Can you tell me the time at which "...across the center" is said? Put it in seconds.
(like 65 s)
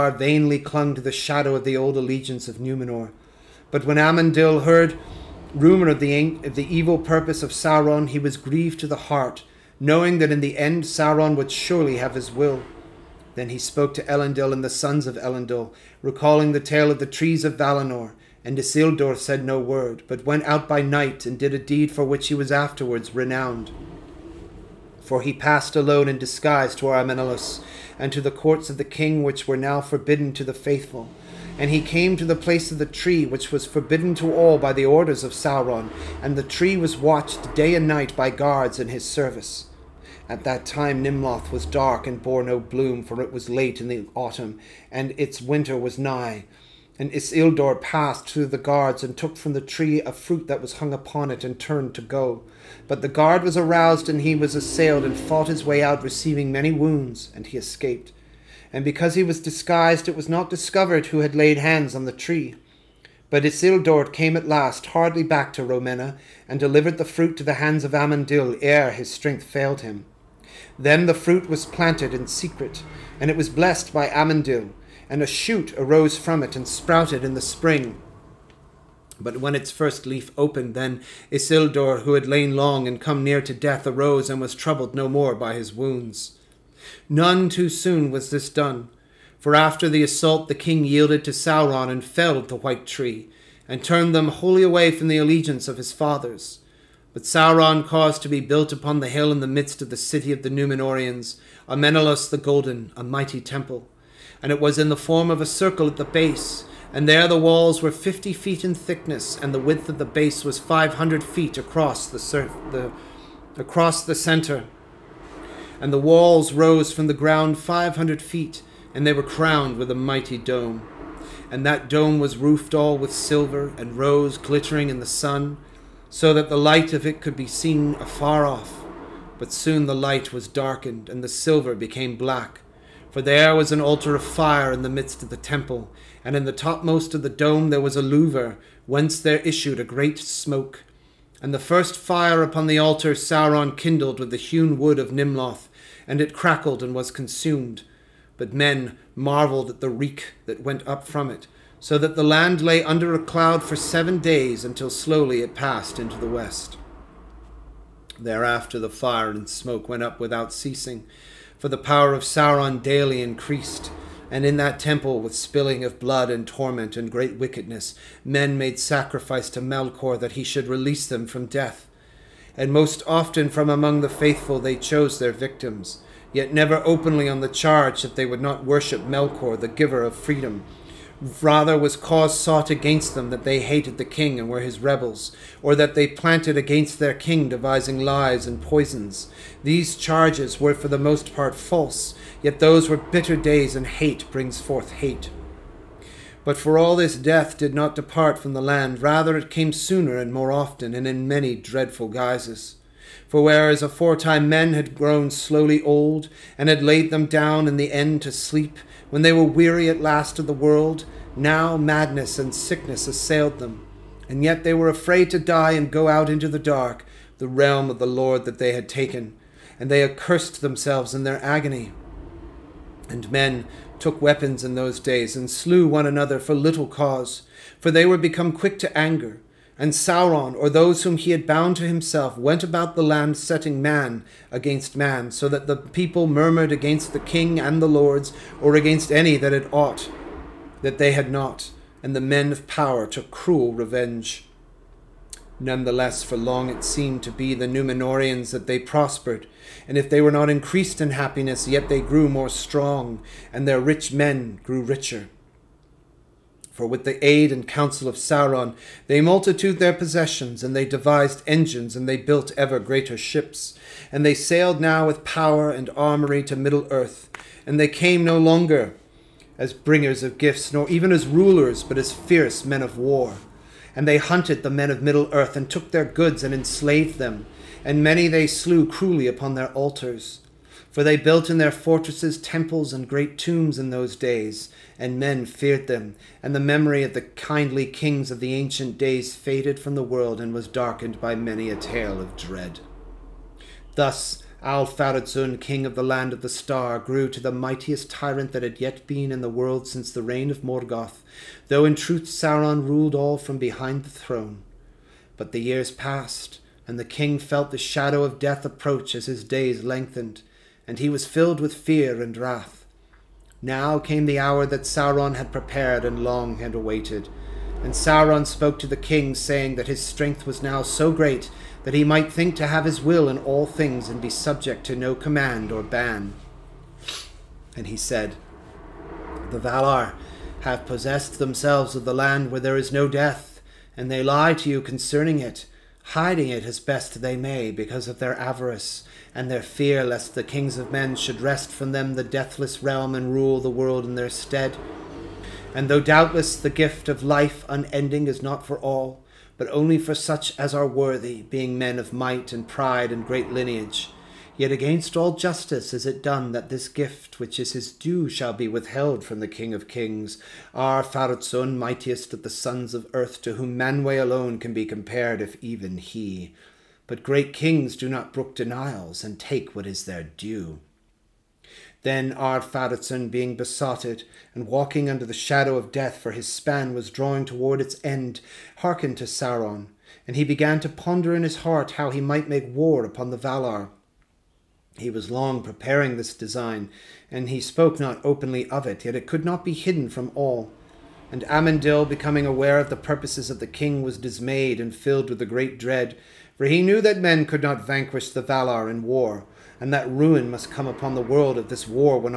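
113 s.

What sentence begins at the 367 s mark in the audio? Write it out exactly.
But great kings do not brook denials, and take what is their due.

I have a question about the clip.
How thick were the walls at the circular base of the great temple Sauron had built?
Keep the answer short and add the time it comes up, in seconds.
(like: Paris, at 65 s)
50 feet, at 107 s.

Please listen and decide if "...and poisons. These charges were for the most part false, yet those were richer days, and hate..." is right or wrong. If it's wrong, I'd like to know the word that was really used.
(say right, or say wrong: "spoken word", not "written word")
wrong: "bitter", not "richer".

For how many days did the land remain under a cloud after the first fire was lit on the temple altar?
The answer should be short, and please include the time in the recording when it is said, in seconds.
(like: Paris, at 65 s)
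7, at 153 s.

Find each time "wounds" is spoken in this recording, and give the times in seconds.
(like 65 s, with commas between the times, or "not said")
56 s, 85 s.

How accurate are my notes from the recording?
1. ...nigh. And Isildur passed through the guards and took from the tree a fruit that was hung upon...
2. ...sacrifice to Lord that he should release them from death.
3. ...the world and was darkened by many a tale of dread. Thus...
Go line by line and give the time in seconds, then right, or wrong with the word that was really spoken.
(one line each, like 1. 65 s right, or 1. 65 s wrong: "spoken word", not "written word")
1. 45 s right
2. 168 s wrong: "Melkor", not "Lord"
3. 289 s right.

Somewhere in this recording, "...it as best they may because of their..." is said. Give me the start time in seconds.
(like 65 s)
336 s.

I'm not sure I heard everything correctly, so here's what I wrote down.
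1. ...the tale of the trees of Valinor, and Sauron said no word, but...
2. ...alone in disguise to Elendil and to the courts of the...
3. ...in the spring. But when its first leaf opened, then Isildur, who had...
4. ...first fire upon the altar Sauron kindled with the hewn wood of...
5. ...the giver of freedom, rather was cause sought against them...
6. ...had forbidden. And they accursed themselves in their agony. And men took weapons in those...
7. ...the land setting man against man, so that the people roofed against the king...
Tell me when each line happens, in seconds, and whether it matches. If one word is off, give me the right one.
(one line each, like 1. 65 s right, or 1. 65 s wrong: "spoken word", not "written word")
1. 16 s wrong: "Isildur", not "Sauron"
2. 25 s wrong: "Armenelos", not "Elendil"
3. 77 s right
4. 141 s right
5. 179 s right
6. 218 s wrong: "taken", not "forbidden"
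7. 232 s wrong: "murmured", not "roofed".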